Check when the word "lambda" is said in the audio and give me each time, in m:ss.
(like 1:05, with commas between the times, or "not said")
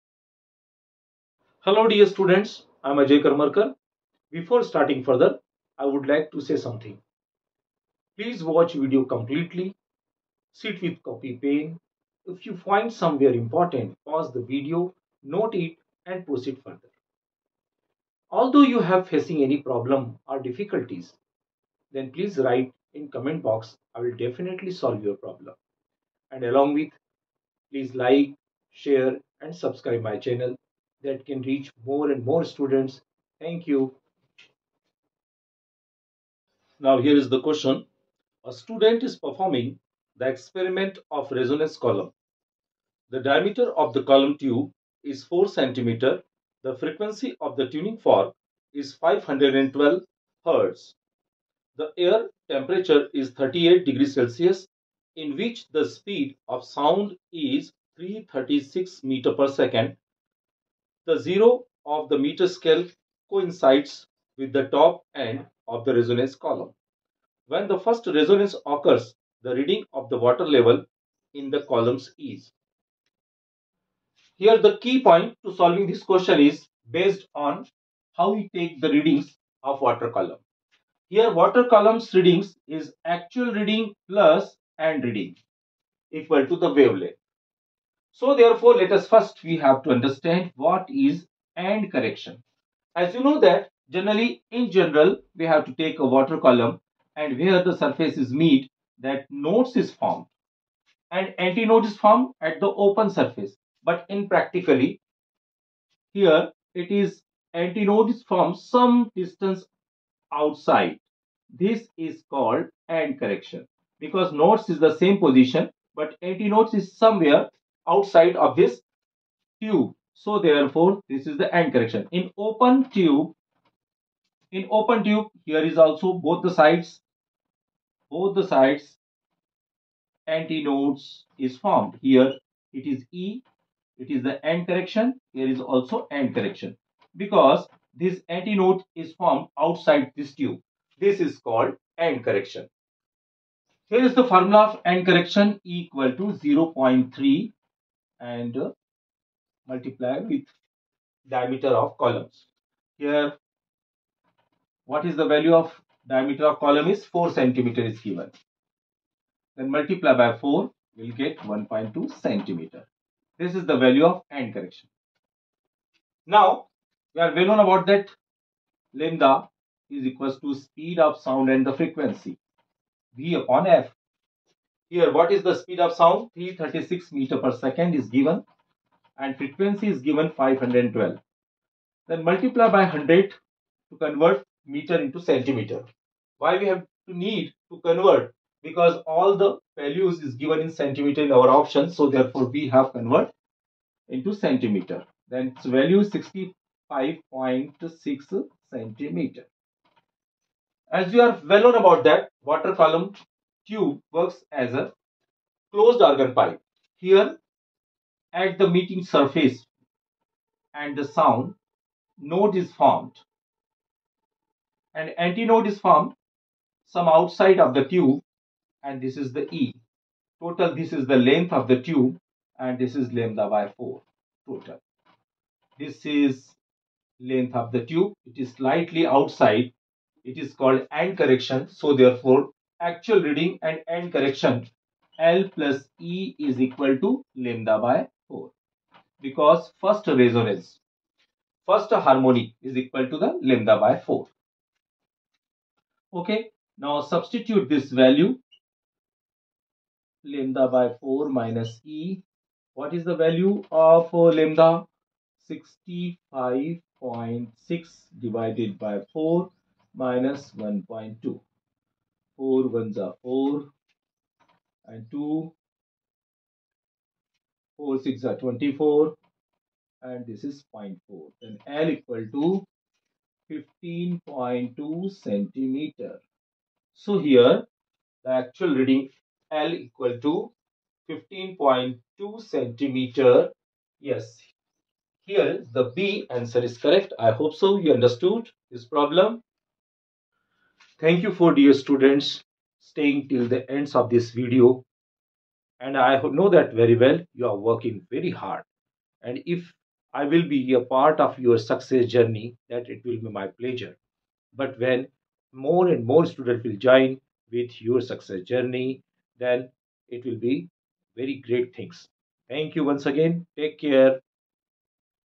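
2:48, 3:43, 3:57, 4:03, 4:10, 4:14.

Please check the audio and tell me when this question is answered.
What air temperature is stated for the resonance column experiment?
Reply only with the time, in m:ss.
0:53.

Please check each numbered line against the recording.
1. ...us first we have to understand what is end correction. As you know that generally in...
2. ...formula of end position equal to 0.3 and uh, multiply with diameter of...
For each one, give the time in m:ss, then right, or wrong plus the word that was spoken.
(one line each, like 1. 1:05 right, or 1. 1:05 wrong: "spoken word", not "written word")
1. 1:28 right
2. 2:24 wrong: "correction", not "position".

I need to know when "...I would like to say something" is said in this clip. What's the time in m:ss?
0:05.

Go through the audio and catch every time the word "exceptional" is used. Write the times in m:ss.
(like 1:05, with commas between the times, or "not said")
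not said.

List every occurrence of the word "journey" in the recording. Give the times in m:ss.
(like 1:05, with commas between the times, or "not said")
5:02, 5:08.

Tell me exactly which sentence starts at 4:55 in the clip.
And I know that very well you are working very hard.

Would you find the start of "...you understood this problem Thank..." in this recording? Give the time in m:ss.
4:47.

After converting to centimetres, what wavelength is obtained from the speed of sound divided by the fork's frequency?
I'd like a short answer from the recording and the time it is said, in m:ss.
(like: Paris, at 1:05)
65.6 cm, at 3:16.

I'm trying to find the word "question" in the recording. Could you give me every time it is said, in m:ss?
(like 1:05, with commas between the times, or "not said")
0:37, 1:16.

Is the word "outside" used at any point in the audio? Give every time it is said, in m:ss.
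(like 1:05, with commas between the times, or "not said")
1:50, 1:57, 2:19, 3:37, 3:49.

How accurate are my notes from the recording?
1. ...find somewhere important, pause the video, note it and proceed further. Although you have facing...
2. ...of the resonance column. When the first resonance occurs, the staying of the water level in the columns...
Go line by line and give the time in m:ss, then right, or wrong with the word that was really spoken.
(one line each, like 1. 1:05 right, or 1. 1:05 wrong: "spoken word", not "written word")
1. 0:12 right
2. 1:05 wrong: "reading", not "staying".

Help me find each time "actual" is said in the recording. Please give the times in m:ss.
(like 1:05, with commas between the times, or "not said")
1:23, 3:52, 4:38.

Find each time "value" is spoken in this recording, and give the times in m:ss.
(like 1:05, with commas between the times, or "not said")
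2:35, 2:43, 3:09, 3:15, 4:08, 4:13.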